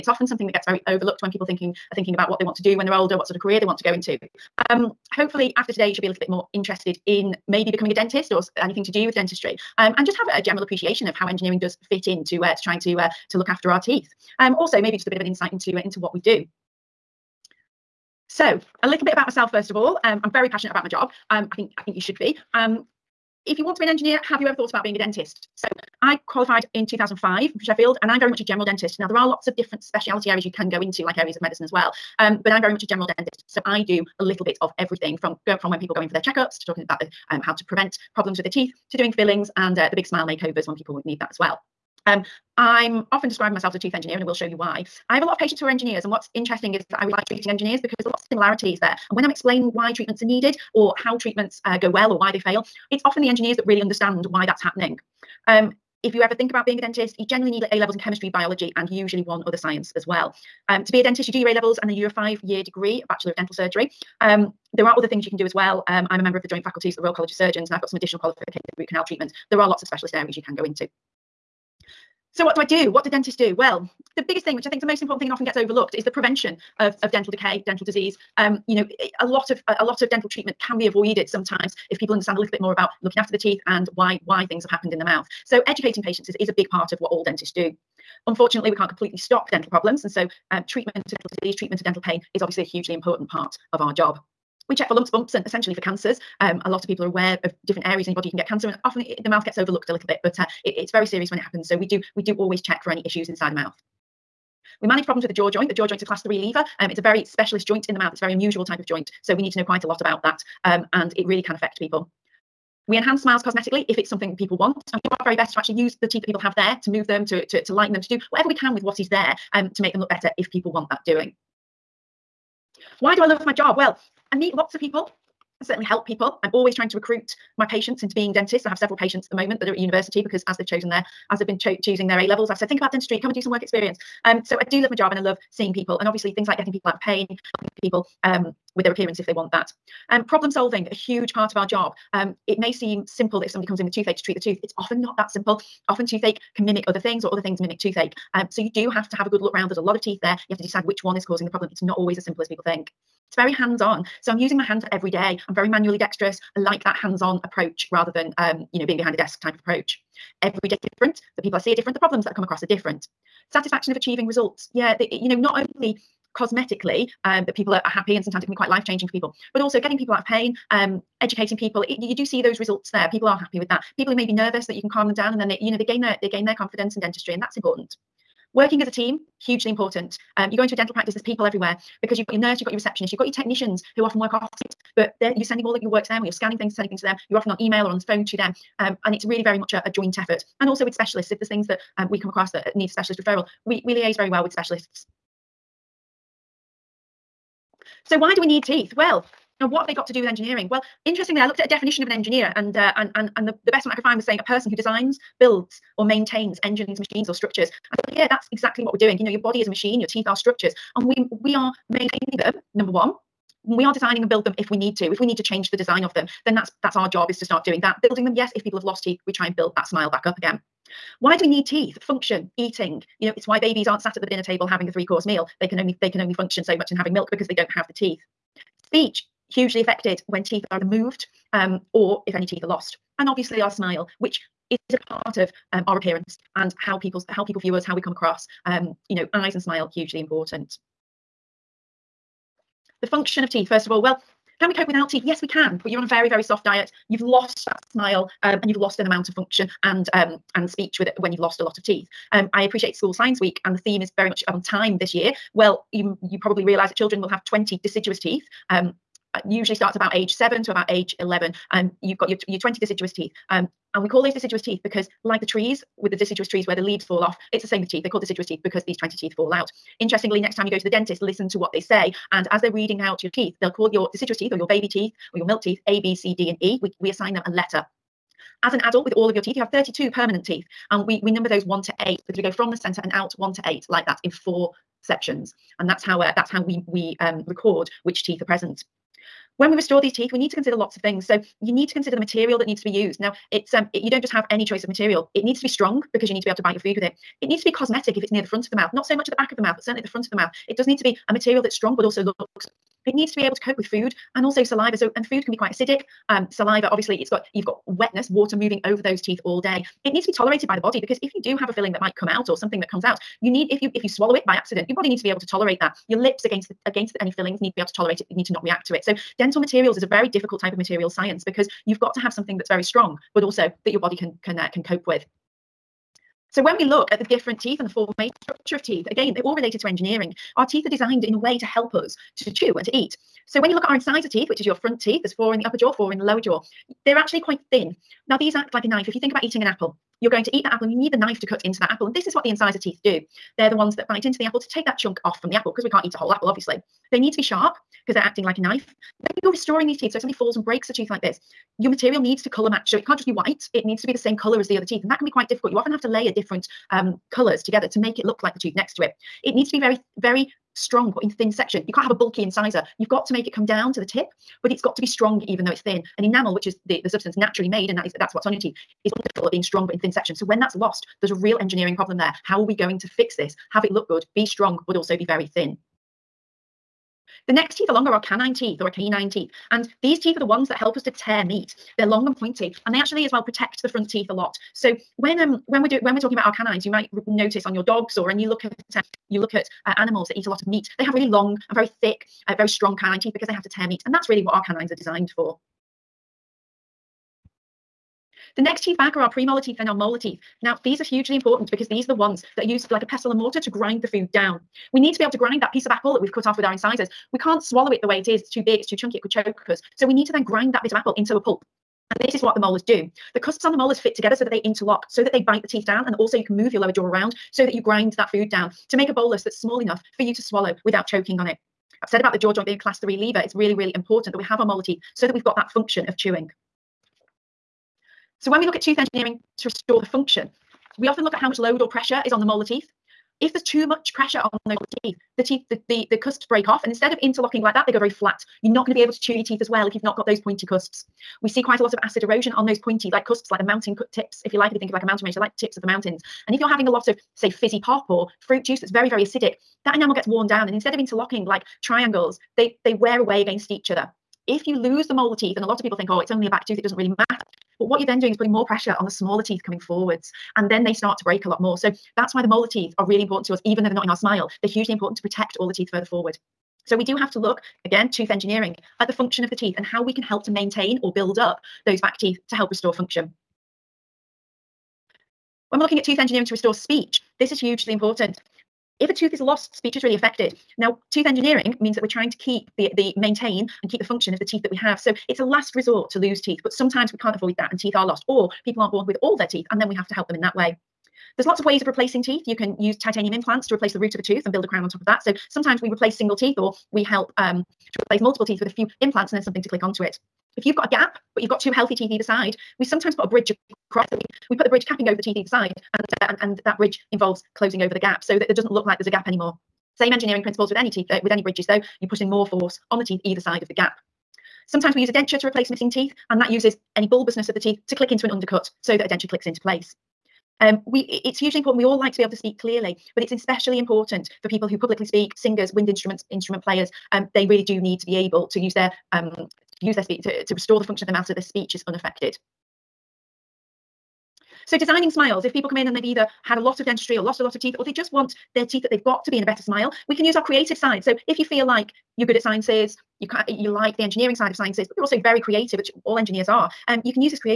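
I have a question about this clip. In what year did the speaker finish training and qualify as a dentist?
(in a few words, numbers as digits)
2005.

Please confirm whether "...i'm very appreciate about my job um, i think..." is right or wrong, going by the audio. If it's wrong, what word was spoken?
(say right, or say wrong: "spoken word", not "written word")
wrong: "passionate", not "appreciate".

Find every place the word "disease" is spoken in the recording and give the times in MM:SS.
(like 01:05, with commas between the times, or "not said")
01:17, 01:31.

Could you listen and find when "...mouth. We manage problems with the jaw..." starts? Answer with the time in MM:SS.
01:43.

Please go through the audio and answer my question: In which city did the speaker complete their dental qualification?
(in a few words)
Sheffield.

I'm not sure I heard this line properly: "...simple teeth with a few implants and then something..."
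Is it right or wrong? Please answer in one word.
wrong.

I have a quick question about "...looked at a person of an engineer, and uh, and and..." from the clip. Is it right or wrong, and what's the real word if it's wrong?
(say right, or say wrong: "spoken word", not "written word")
wrong: "definition", not "person".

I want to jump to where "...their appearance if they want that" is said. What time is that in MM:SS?
02:18.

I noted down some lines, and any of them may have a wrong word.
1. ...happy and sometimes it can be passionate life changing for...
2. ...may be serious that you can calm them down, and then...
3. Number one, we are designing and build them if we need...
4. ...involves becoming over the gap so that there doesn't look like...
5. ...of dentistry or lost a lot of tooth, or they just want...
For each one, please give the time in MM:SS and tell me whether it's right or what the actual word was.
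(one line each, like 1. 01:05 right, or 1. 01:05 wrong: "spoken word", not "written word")
1. 02:47 wrong: "quite", not "passionate"
2. 02:54 wrong: "nervous", not "serious"
3. 03:32 right
4. 08:27 wrong: "closing", not "becoming"
5. 08:56 wrong: "teeth", not "tooth".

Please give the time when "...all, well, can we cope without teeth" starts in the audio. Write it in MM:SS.
04:03.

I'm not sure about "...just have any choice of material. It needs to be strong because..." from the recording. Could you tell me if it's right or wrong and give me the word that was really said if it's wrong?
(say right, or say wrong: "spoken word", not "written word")
right.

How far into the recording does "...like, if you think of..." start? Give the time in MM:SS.
07:24.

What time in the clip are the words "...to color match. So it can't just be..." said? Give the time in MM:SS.
05:52.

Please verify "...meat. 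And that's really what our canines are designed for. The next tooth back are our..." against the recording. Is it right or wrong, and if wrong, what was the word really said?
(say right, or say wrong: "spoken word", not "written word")
wrong: "teeth", not "tooth".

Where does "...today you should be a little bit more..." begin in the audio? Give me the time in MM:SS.
00:05.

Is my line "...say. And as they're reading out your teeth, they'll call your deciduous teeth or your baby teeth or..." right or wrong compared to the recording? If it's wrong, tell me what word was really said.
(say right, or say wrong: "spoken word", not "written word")
right.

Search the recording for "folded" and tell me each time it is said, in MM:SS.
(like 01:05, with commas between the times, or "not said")
not said.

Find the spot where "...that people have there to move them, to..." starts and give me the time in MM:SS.
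01:56.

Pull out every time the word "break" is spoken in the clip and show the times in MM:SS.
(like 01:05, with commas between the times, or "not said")
05:50, 07:16, 07:41.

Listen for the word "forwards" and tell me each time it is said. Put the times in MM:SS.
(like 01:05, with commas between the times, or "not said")
07:39, 07:46.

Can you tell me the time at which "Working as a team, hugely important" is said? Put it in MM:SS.
02:58.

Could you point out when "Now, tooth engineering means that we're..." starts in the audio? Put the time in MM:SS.
08:00.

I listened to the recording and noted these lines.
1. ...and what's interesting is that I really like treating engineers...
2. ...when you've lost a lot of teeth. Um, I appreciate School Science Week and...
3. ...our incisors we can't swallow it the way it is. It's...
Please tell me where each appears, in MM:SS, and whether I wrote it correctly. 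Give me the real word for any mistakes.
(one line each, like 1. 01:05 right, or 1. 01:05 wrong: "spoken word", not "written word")
1. 00:46 right
2. 04:11 right
3. 06:46 right.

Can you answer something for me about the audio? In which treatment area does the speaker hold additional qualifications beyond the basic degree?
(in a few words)
root canal treatment.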